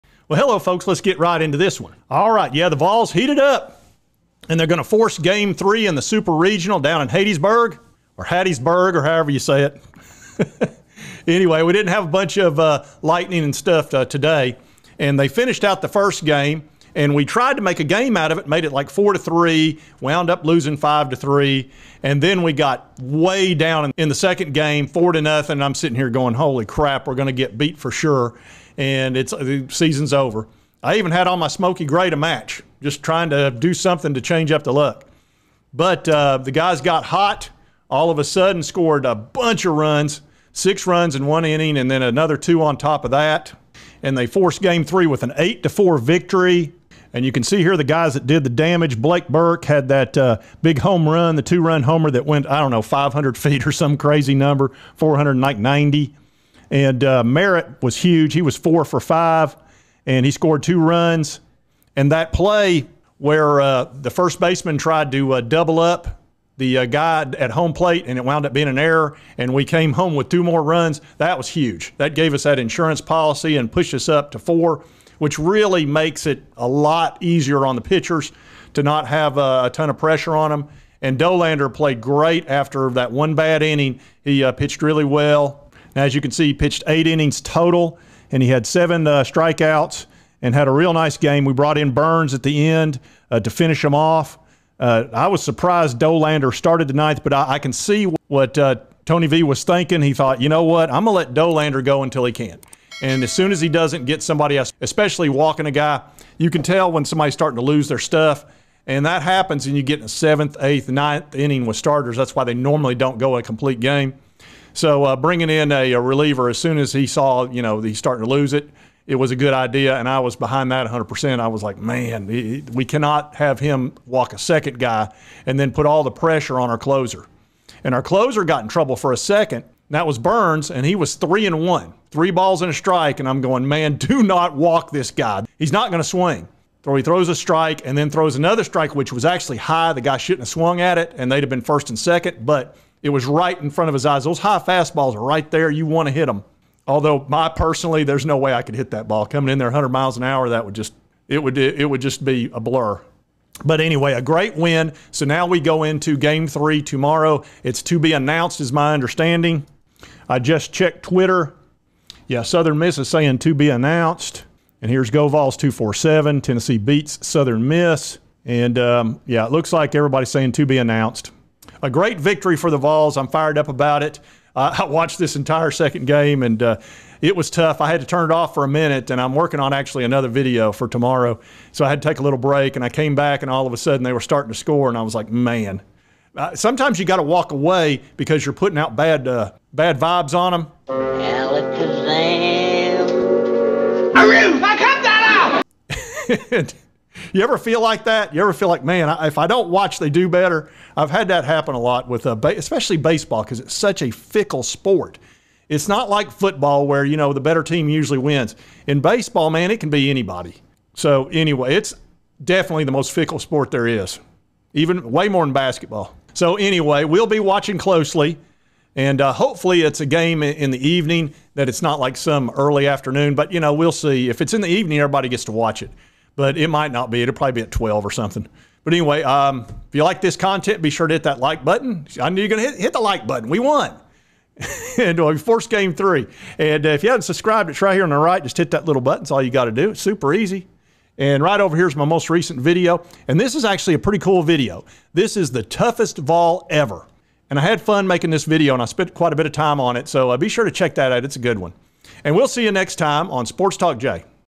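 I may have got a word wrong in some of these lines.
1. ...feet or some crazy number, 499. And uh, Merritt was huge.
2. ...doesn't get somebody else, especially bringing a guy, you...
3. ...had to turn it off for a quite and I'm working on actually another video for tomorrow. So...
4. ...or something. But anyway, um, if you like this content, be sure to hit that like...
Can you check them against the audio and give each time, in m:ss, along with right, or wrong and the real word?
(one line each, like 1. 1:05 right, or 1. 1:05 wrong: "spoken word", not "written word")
1. 0:53 wrong: "490", not "499"
2. 1:43 wrong: "walking", not "bringing"
3. 2:57 wrong: "minute", not "quite"
4. 3:48 right.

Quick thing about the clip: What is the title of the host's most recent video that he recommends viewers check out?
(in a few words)
The toughest Vol ever.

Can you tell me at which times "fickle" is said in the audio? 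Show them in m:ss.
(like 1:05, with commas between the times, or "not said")
3:24, 3:33.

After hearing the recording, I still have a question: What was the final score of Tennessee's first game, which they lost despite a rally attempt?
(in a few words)
5-3.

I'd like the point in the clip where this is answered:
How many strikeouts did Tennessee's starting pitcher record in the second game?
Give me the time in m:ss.
1:28.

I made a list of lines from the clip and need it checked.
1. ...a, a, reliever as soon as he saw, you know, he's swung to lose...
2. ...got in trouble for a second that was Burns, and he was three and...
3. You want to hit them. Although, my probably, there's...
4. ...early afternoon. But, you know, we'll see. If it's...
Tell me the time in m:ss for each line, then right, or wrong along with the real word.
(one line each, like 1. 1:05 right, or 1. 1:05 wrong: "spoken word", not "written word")
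1. 1:55 wrong: "starting", not "swung"
2. 2:08 right
3. 2:25 wrong: "personally", not "probably"
4. 3:42 right.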